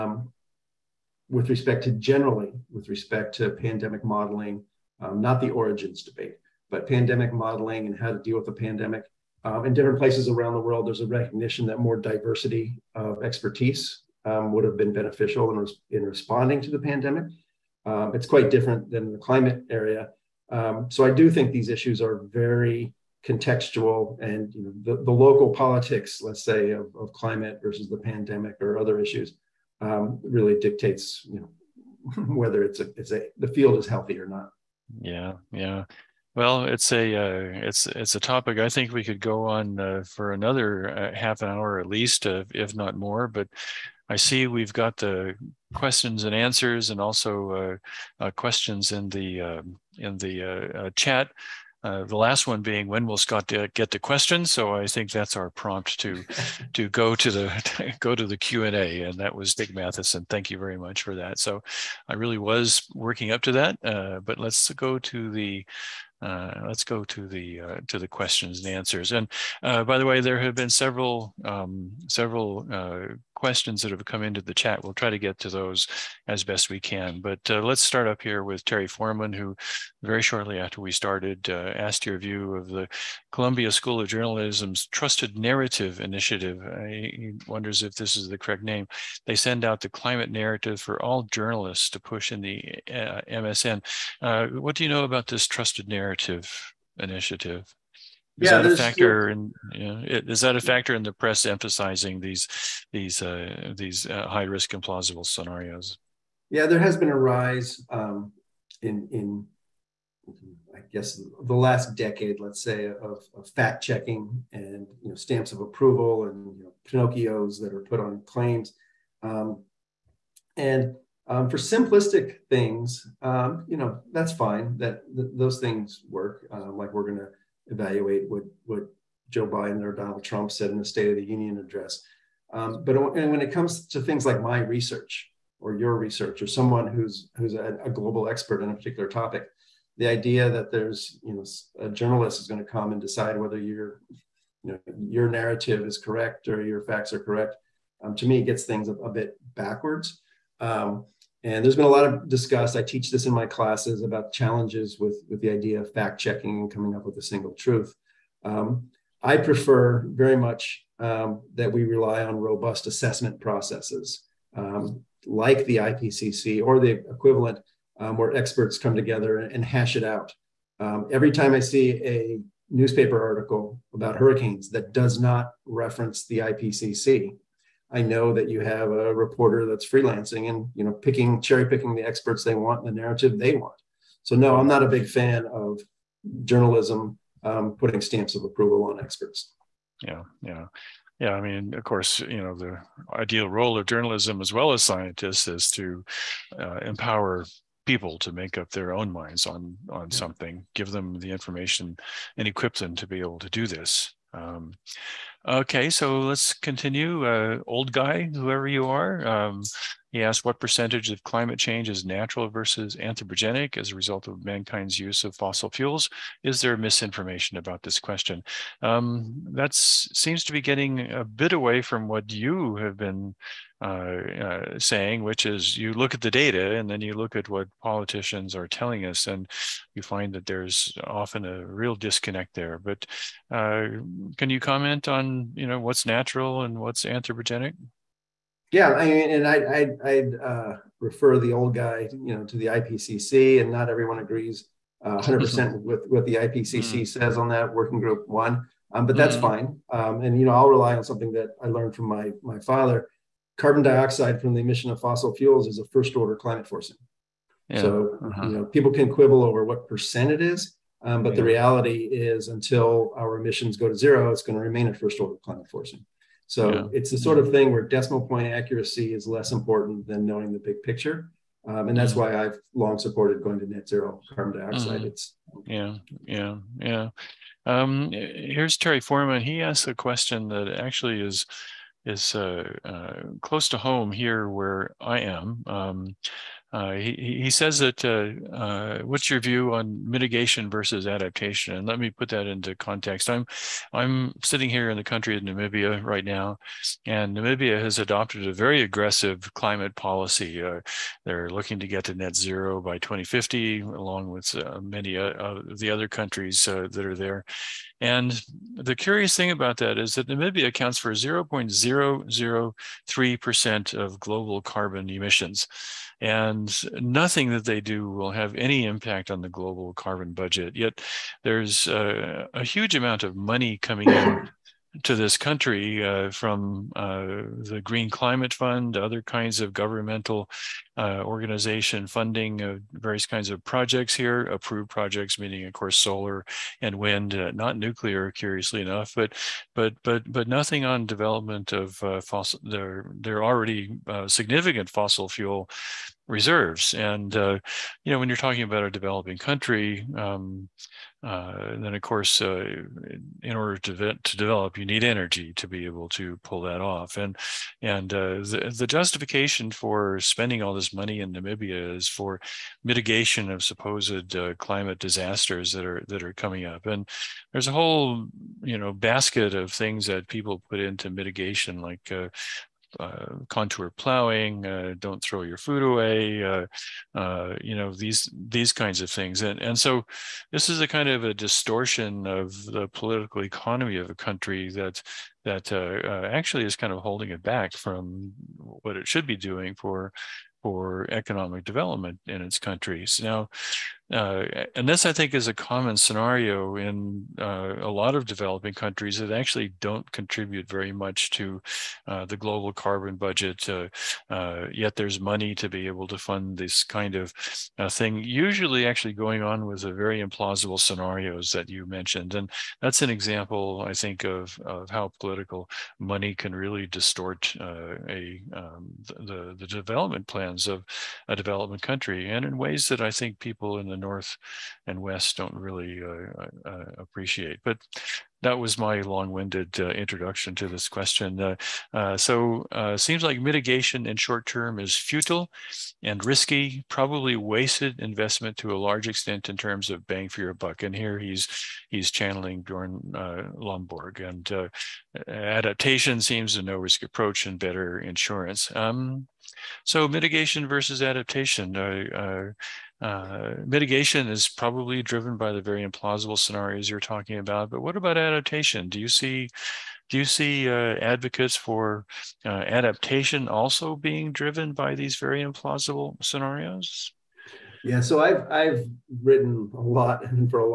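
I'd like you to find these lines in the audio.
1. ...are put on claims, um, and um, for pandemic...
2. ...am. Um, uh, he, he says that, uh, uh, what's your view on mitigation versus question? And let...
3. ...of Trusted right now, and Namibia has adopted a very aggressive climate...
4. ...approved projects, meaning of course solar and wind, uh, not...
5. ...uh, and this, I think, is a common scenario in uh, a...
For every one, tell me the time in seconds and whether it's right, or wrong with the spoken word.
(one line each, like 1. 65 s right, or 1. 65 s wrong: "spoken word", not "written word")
1. 117 s wrong: "simplistic", not "pandemic"
2. 285 s wrong: "adaptation", not "question"
3. 295 s wrong: "Namibia", not "Trusted"
4. 334 s right
5. 394 s right.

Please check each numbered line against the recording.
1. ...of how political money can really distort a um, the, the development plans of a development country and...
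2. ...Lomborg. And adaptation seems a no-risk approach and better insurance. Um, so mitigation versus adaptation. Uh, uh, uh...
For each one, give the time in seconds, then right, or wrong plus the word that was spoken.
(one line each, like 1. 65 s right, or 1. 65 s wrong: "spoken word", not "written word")
1. 414 s right
2. 443 s right.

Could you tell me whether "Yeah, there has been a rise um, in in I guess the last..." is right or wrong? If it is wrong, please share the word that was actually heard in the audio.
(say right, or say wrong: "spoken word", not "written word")
right.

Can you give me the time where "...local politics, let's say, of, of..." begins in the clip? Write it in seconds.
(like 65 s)
25 s.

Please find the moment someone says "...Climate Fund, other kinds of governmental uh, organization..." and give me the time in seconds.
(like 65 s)
328 s.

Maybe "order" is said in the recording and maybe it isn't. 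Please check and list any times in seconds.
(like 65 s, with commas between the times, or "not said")
256 s, 265 s, 353 s.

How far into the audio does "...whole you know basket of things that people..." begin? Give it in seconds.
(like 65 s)
367 s.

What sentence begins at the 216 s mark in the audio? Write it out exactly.
Is there misinformation about this question?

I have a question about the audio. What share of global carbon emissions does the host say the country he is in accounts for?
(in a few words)
0.003%.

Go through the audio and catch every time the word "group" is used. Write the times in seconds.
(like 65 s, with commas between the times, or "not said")
247 s.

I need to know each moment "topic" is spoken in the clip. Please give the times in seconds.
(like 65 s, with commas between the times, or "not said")
38 s, 139 s.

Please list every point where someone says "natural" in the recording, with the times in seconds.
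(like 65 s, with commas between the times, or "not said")
212 s, 236 s.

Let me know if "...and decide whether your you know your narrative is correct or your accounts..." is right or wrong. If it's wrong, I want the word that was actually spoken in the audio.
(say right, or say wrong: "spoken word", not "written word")
wrong: "facts", not "accounts".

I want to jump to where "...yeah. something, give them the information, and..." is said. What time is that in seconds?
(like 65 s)
200 s.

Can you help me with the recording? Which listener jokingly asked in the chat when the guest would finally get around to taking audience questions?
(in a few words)
Dick Matheson.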